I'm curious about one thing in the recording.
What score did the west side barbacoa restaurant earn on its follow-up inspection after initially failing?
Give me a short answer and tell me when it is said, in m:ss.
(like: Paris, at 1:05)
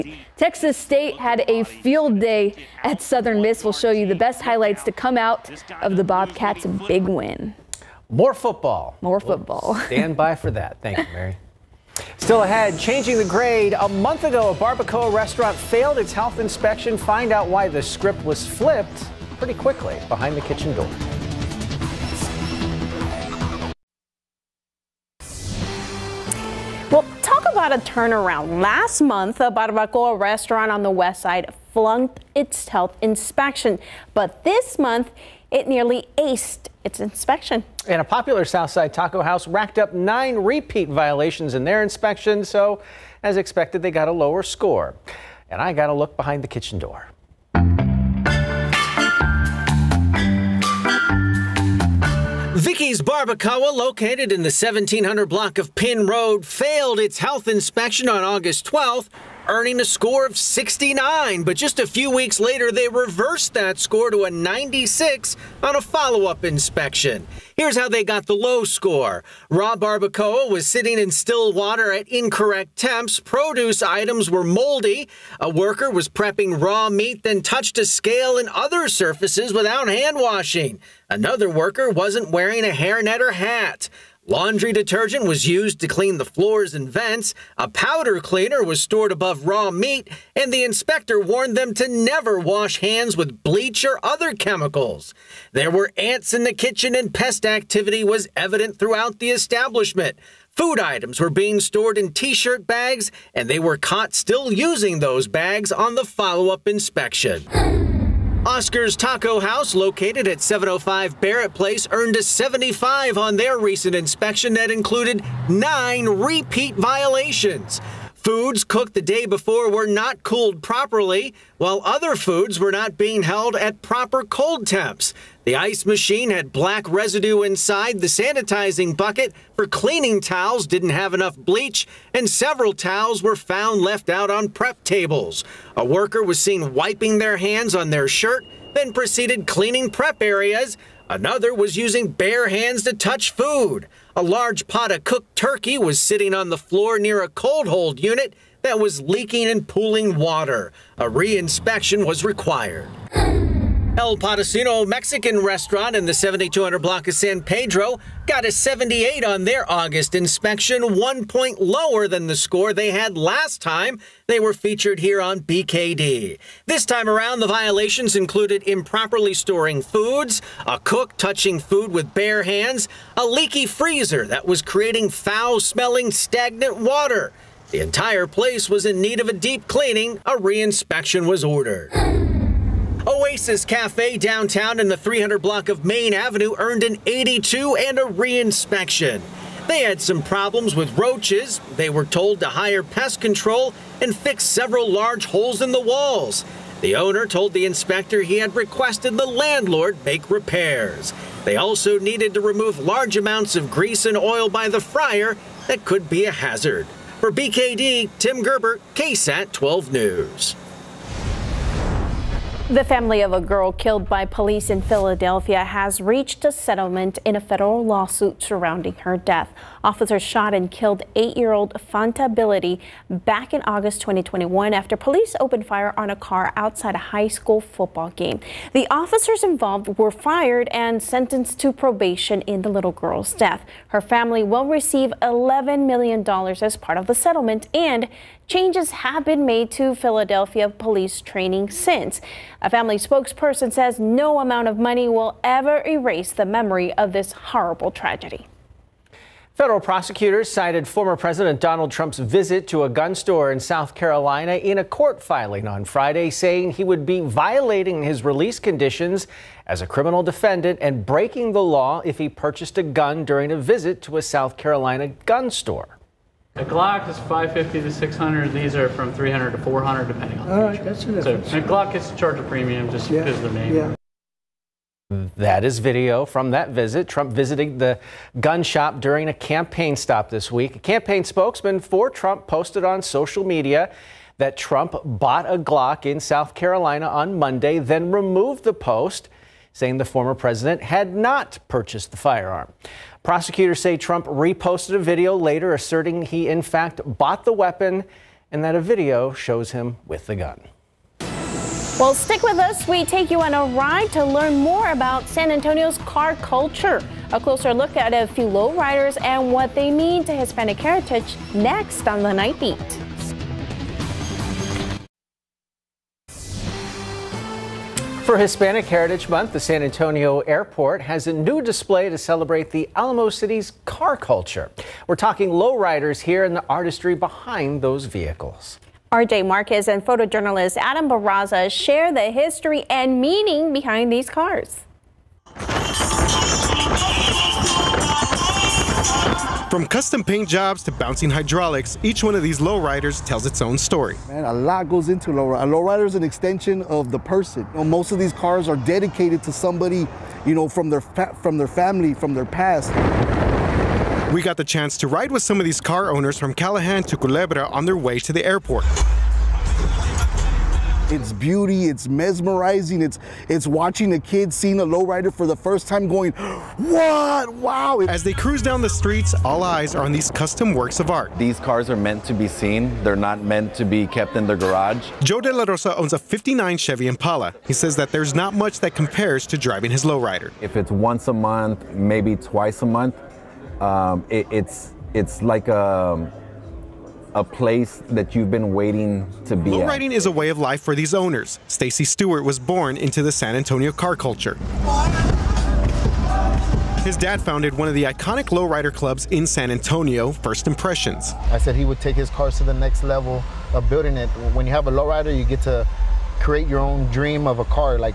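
96, at 1:04.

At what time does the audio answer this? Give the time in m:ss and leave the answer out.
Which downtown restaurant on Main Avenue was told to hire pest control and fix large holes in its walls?
3:03.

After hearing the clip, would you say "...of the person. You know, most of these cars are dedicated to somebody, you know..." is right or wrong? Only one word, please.
right.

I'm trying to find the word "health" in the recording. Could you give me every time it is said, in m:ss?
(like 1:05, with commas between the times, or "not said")
0:16, 0:32, 0:57.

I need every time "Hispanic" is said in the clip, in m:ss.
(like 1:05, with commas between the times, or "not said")
5:10, 5:18.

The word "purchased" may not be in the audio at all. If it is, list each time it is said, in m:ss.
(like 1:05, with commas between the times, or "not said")
4:22, 4:51.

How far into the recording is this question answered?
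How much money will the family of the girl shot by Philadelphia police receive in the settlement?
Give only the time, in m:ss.
3:55.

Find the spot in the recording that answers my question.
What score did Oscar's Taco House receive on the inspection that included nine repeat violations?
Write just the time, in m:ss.
1:52.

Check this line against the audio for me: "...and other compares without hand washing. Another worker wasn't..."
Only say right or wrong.
wrong.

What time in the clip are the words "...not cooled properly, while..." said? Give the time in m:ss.
1:59.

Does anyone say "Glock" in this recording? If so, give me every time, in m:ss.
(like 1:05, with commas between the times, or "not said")
4:26, 4:31, 4:45.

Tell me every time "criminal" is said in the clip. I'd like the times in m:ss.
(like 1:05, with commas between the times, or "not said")
4:19.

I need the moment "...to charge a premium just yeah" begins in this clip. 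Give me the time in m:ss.
4:32.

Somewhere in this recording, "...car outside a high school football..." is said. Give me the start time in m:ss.
3:46.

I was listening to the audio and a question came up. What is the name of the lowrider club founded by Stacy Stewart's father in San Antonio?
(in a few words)
First Impressions.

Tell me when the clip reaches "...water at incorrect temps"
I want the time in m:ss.
1:11.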